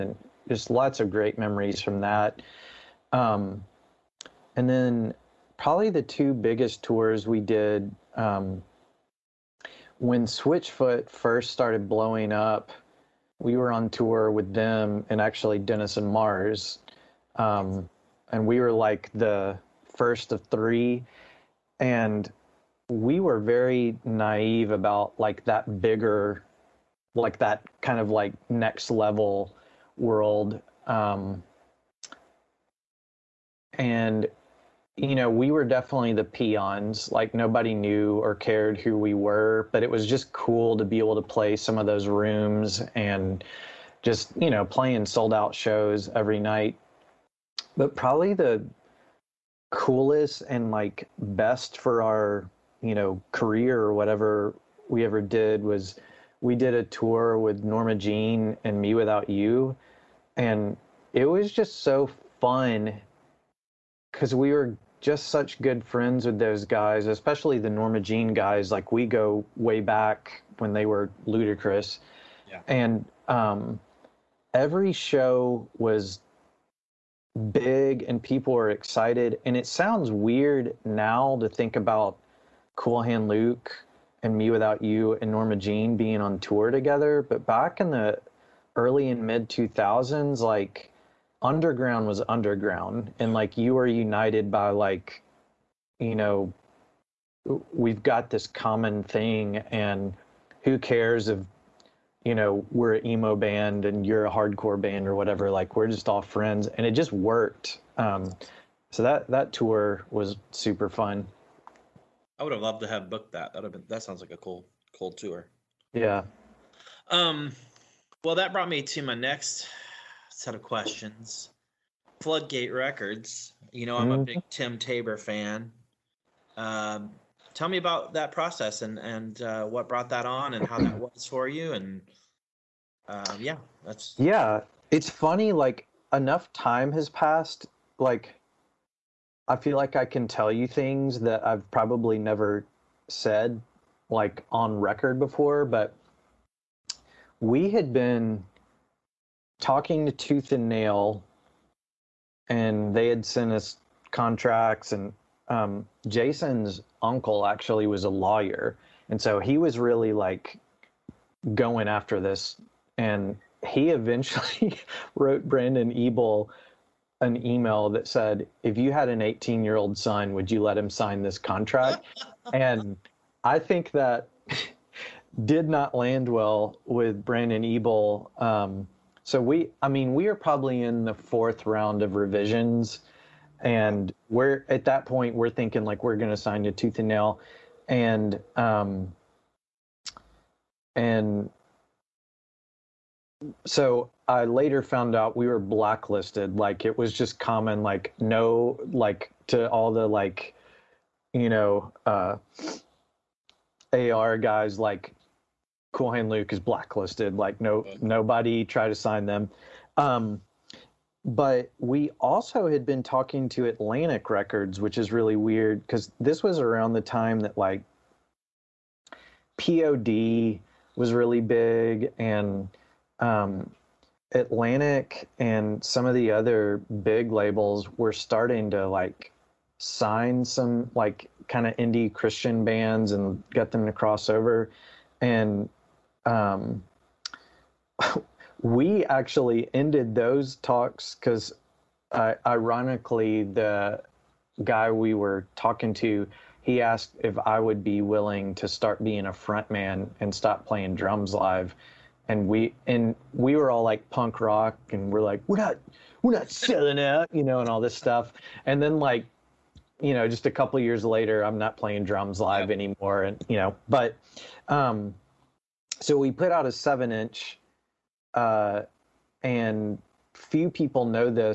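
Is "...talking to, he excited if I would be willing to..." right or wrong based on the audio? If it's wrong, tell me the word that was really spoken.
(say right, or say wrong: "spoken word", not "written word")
wrong: "asked", not "excited".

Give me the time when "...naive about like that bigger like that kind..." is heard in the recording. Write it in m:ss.
0:24.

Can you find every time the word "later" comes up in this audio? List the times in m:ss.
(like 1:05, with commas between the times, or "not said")
3:14, 4:21.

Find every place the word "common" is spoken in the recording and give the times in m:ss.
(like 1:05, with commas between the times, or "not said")
1:38, 3:17.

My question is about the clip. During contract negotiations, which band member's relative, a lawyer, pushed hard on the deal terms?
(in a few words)
Jason's uncle.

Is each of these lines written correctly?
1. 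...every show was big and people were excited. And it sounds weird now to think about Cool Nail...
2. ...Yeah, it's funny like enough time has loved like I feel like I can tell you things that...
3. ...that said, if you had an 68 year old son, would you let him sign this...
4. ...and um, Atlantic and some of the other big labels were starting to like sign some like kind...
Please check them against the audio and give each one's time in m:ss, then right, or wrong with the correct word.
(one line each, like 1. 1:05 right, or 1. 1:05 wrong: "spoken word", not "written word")
1. 1:14 wrong: "Hand", not "Nail"
2. 2:14 wrong: "passed", not "loved"
3. 2:47 wrong: "18", not "68"
4. 3:42 right.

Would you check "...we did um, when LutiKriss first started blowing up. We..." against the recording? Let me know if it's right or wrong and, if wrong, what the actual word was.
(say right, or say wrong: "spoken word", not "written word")
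wrong: "Switchfoot", not "LutiKriss".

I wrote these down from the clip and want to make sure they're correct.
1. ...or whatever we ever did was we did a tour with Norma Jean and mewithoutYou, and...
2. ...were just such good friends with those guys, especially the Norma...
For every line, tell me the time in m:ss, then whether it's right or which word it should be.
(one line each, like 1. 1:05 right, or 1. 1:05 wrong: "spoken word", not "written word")
1. 0:53 right
2. 1:04 right.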